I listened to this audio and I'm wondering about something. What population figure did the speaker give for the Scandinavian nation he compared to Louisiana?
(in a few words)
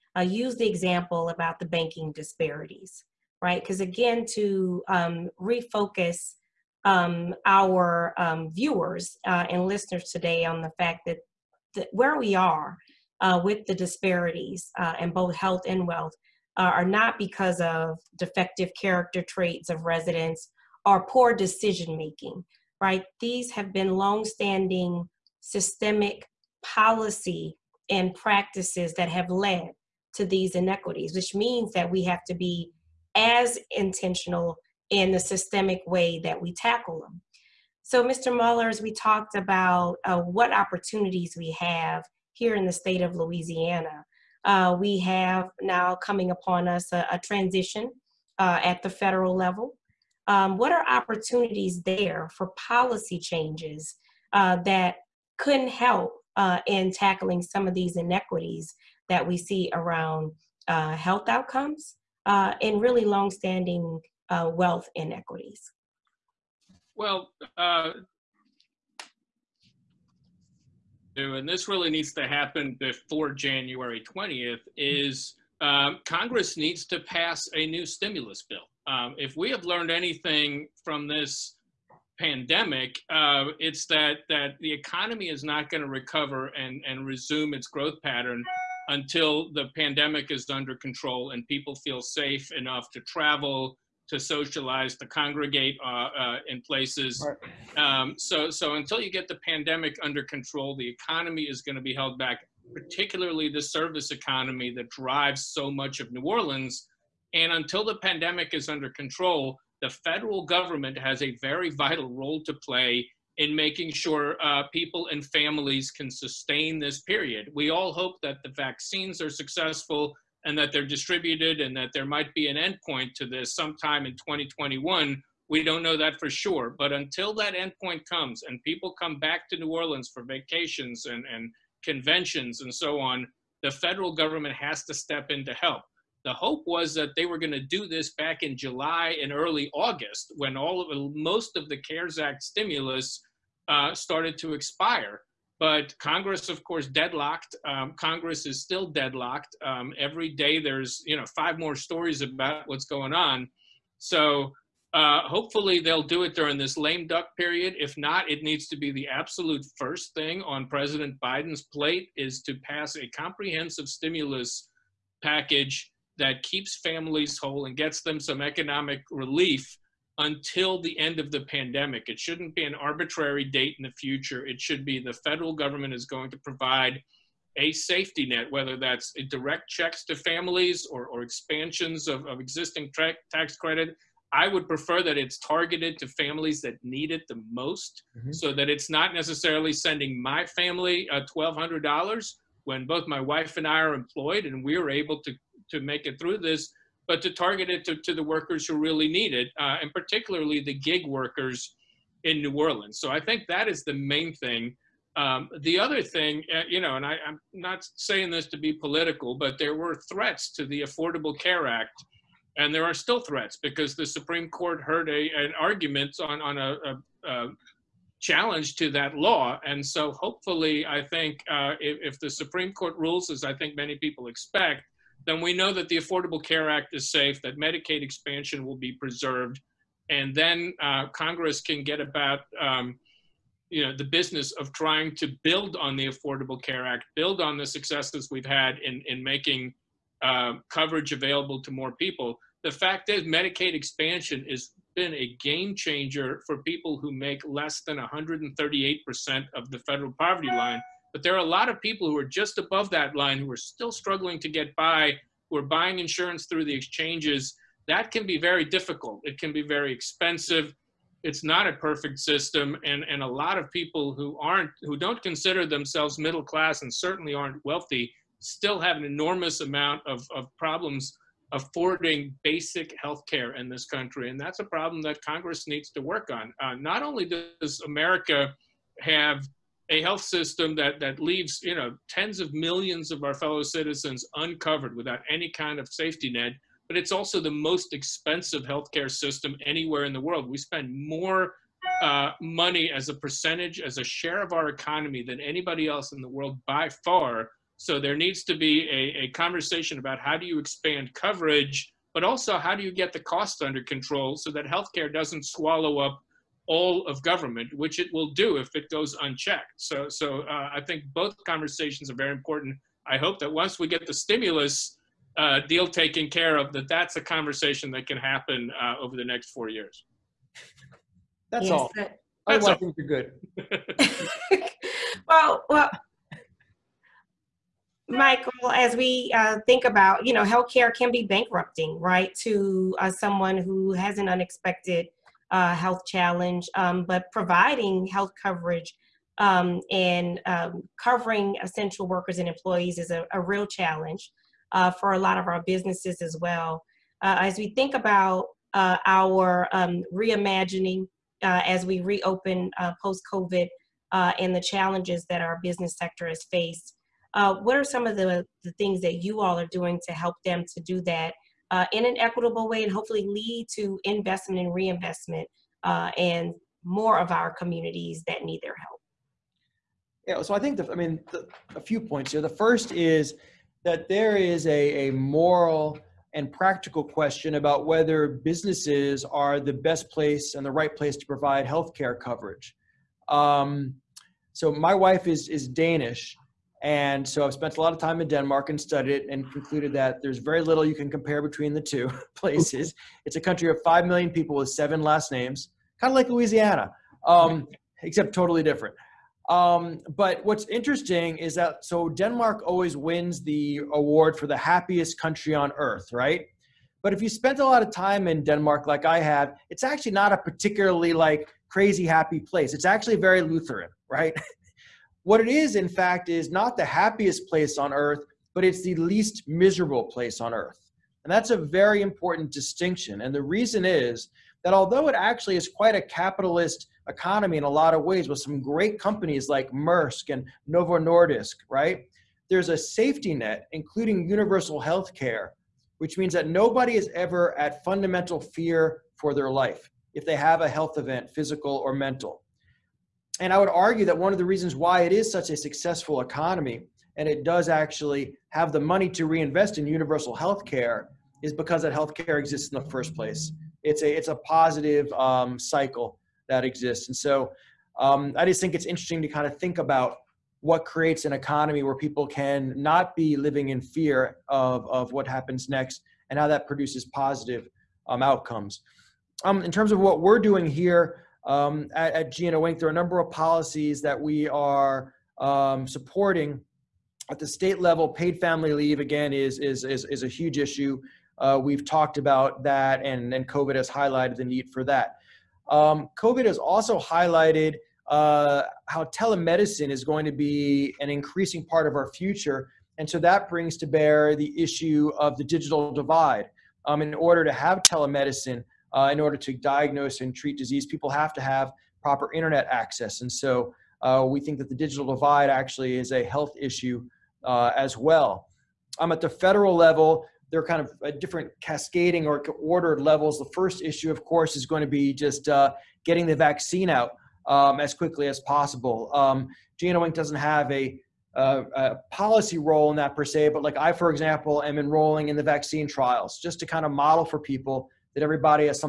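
5 million.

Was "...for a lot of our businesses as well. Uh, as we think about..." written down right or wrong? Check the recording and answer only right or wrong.
right.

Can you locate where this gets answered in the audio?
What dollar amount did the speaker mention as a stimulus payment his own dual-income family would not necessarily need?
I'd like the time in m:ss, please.
3:11.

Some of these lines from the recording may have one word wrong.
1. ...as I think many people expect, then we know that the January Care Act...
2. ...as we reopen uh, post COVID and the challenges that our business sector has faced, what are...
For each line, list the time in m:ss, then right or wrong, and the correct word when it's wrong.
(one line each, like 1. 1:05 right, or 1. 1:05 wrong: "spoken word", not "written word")
1. 3:43 wrong: "Affordable", not "January"
2. 5:51 right.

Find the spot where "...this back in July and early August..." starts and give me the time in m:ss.
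2:17.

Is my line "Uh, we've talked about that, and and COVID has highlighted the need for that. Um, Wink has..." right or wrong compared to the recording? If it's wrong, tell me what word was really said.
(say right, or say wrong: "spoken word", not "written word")
wrong: "COVID", not "Wink".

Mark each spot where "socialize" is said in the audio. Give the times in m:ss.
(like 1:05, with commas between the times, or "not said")
1:34.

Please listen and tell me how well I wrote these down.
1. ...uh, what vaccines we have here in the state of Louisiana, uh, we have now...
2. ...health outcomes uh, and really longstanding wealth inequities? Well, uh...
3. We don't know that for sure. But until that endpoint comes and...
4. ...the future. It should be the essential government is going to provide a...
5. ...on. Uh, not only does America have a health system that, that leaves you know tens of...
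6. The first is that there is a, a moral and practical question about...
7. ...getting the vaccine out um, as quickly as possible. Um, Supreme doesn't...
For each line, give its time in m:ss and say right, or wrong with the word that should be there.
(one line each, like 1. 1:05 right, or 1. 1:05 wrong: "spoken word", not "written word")
1. 0:40 wrong: "opportunities", not "vaccines"
2. 1:00 right
3. 2:05 right
4. 2:53 wrong: "federal", not "essential"
5. 4:36 right
6. 6:12 right
7. 8:36 wrong: "Wink", not "Supreme".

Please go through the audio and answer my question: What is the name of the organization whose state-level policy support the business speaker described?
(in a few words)
GNO, Inc.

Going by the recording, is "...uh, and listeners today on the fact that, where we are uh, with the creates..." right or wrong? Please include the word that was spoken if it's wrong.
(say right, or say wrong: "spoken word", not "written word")
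wrong: "disparities", not "creates".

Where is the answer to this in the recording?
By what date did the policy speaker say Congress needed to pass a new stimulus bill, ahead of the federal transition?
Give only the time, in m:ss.
1:13.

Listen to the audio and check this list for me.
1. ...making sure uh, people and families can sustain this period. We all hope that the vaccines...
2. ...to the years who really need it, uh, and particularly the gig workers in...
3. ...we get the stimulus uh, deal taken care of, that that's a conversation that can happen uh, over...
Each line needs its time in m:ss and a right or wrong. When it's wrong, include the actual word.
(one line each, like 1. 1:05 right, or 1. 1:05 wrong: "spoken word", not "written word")
1. 1:53 right
2. 3:17 wrong: "workers", not "years"
3. 5:13 right.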